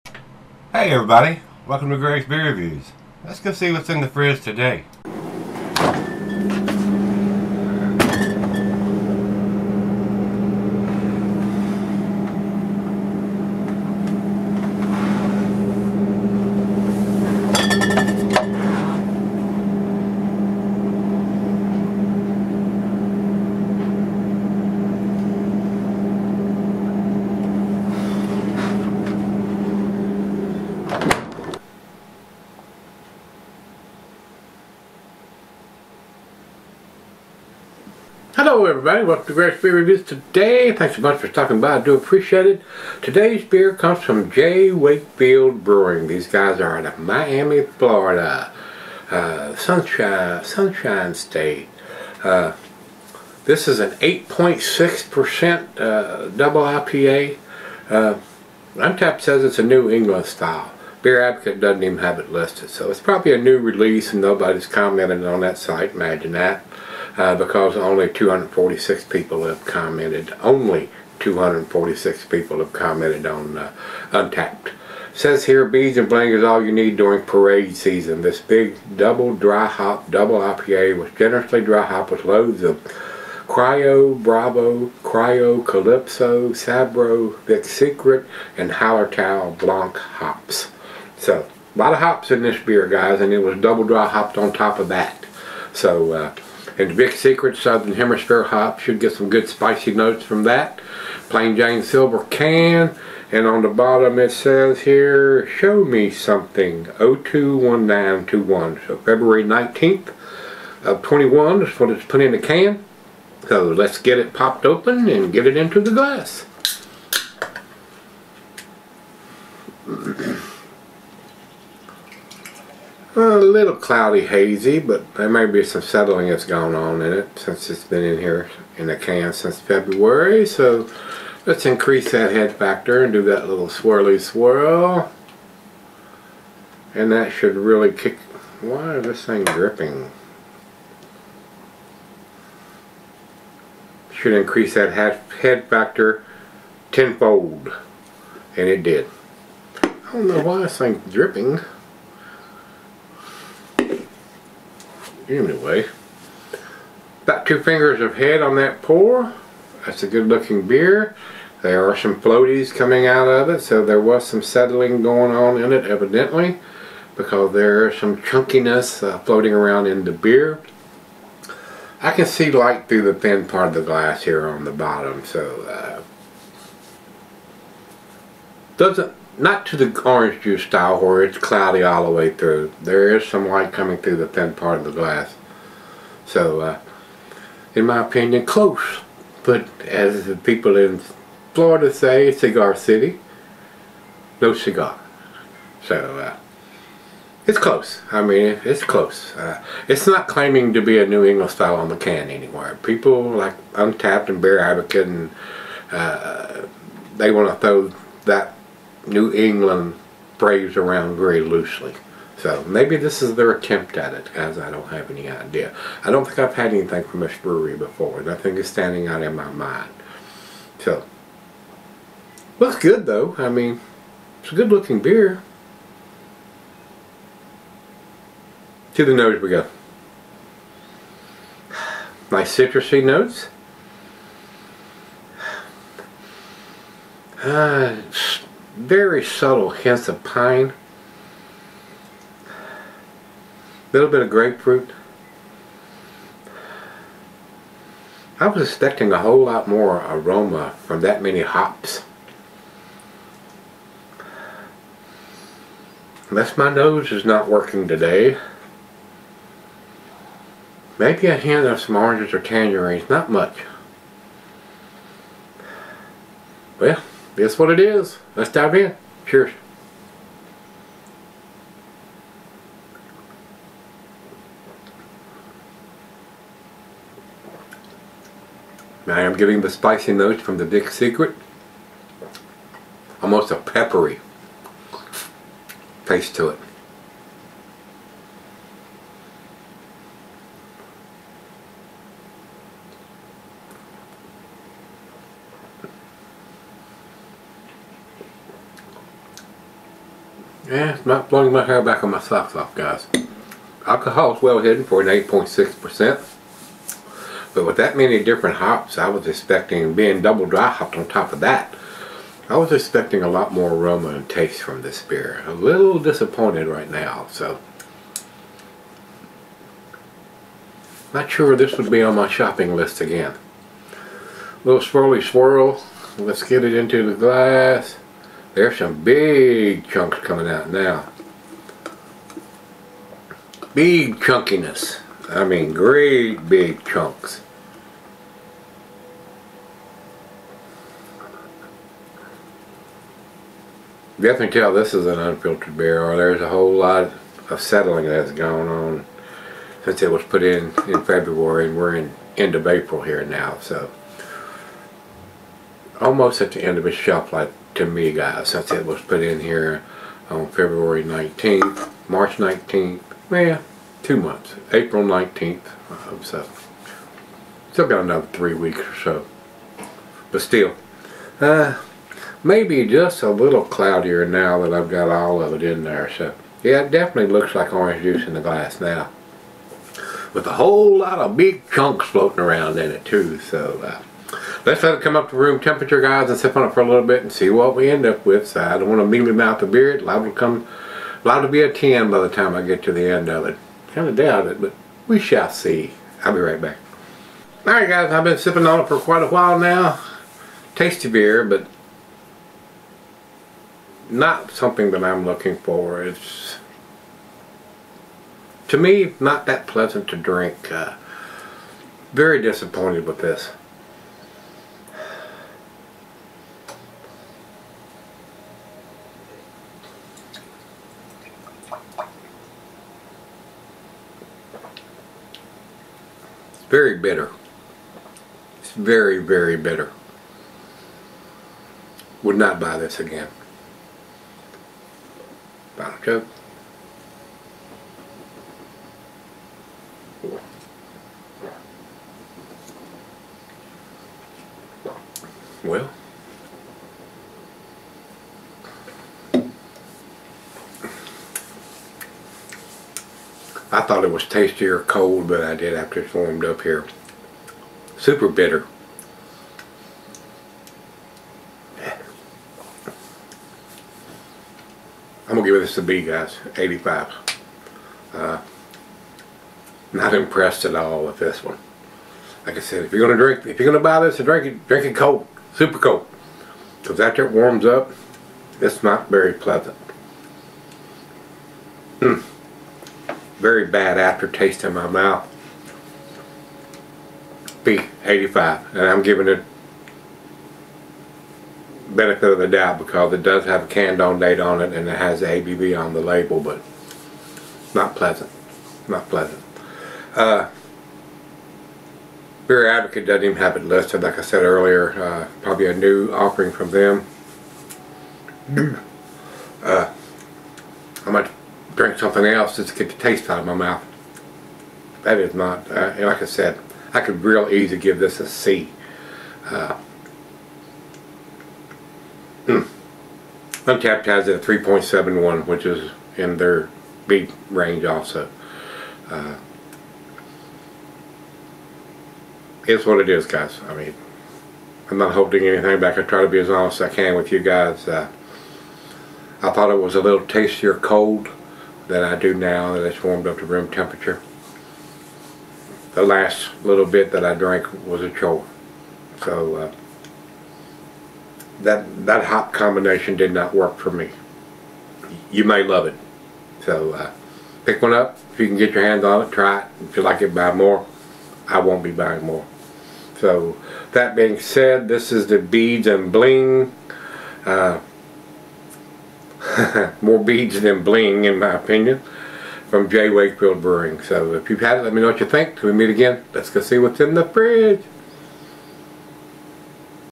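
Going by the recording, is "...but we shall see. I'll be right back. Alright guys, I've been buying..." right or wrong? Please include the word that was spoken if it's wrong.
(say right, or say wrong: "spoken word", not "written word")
wrong: "sipping", not "buying".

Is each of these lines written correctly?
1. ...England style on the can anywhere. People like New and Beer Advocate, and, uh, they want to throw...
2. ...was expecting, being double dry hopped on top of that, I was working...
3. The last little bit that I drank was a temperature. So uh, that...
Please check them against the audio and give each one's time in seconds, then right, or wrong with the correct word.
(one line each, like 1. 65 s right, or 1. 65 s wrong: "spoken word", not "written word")
1. 201 s wrong: "Untappd", not "New"
2. 309 s wrong: "expecting", not "working"
3. 545 s wrong: "chore", not "temperature".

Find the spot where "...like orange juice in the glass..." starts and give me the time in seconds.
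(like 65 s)
377 s.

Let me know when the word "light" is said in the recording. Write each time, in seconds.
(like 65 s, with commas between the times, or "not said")
172 s, 183 s.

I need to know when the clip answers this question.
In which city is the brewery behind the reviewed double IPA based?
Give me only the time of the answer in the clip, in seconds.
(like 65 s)
46 s.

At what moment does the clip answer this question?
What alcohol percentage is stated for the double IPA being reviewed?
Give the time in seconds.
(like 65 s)
53 s.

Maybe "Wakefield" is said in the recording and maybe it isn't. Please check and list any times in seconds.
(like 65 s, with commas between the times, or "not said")
44 s, 573 s.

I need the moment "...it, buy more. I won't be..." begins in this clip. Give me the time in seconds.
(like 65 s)
560 s.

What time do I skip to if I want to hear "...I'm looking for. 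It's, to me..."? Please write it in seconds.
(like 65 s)
405 s.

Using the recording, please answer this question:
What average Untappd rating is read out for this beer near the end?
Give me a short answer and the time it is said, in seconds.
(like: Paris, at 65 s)
3.71, at 524 s.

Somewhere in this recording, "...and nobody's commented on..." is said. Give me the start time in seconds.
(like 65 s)
64 s.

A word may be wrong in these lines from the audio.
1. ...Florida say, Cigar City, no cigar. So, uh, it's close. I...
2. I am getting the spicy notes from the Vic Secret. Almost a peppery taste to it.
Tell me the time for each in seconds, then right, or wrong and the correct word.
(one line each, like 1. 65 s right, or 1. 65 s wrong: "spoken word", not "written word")
1. 191 s right
2. 279 s right.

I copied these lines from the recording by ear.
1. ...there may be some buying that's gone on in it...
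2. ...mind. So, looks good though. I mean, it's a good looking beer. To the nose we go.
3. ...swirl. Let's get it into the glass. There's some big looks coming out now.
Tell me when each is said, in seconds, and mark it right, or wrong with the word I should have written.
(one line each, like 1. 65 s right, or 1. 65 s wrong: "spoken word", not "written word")
1. 125 s wrong: "settling", not "buying"
2. 219 s right
3. 325 s wrong: "chunks", not "looks".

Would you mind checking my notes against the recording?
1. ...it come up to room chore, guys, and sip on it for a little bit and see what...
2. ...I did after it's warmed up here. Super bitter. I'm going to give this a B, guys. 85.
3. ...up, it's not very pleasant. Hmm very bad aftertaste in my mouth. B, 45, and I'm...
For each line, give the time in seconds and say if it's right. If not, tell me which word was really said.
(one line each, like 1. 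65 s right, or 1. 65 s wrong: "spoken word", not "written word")
1. 384 s wrong: "temperature", not "chore"
2. 455 s right
3. 477 s wrong: "85", not "45".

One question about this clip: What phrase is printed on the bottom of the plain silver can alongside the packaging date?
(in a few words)
Show me something.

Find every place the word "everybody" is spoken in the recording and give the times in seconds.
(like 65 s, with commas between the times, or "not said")
0 s, 38 s.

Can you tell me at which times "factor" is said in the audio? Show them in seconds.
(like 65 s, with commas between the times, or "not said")
132 s, 145 s.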